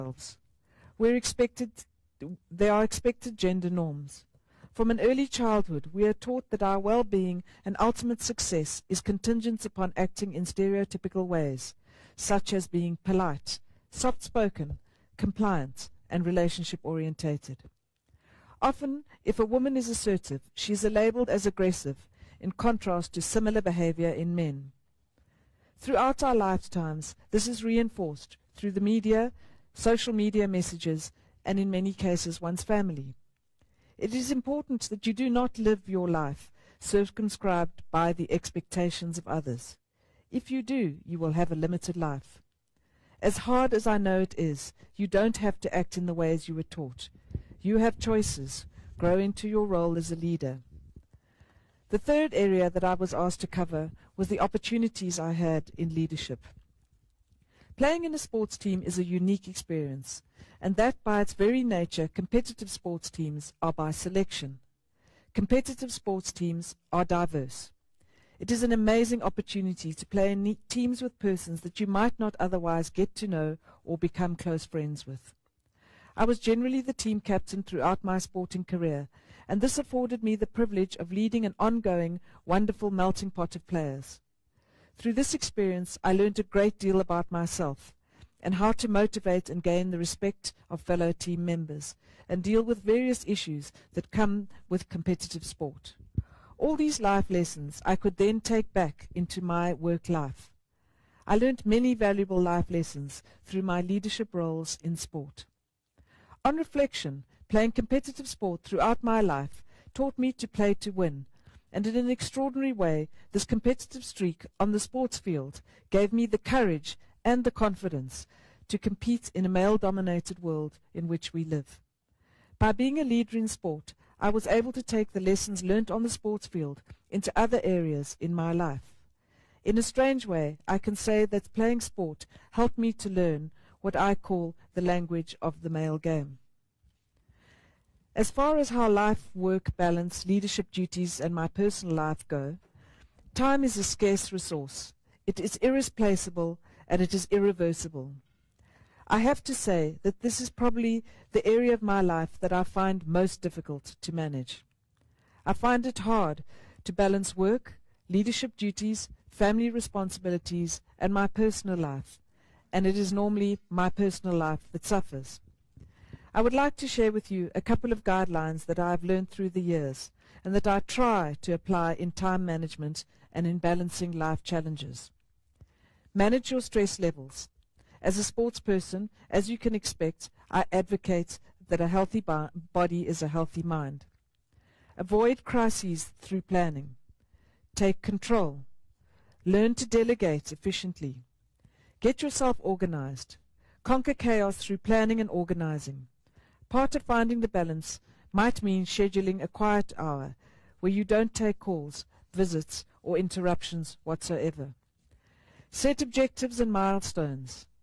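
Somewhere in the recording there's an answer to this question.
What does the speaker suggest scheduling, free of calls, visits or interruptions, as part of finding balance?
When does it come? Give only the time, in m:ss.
3:19.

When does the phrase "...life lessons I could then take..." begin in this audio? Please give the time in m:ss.
1:37.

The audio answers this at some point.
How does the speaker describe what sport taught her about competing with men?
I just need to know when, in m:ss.
2:14.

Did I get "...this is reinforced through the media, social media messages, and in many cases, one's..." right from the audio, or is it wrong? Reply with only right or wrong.
right.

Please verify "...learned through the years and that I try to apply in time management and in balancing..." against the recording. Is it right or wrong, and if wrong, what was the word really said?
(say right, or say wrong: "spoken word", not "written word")
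right.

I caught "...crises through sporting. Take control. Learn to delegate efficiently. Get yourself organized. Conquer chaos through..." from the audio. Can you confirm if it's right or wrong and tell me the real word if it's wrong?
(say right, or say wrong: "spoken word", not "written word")
wrong: "planning", not "sporting".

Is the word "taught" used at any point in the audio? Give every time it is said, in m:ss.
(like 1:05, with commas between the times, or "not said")
0:06, 0:46, 1:49.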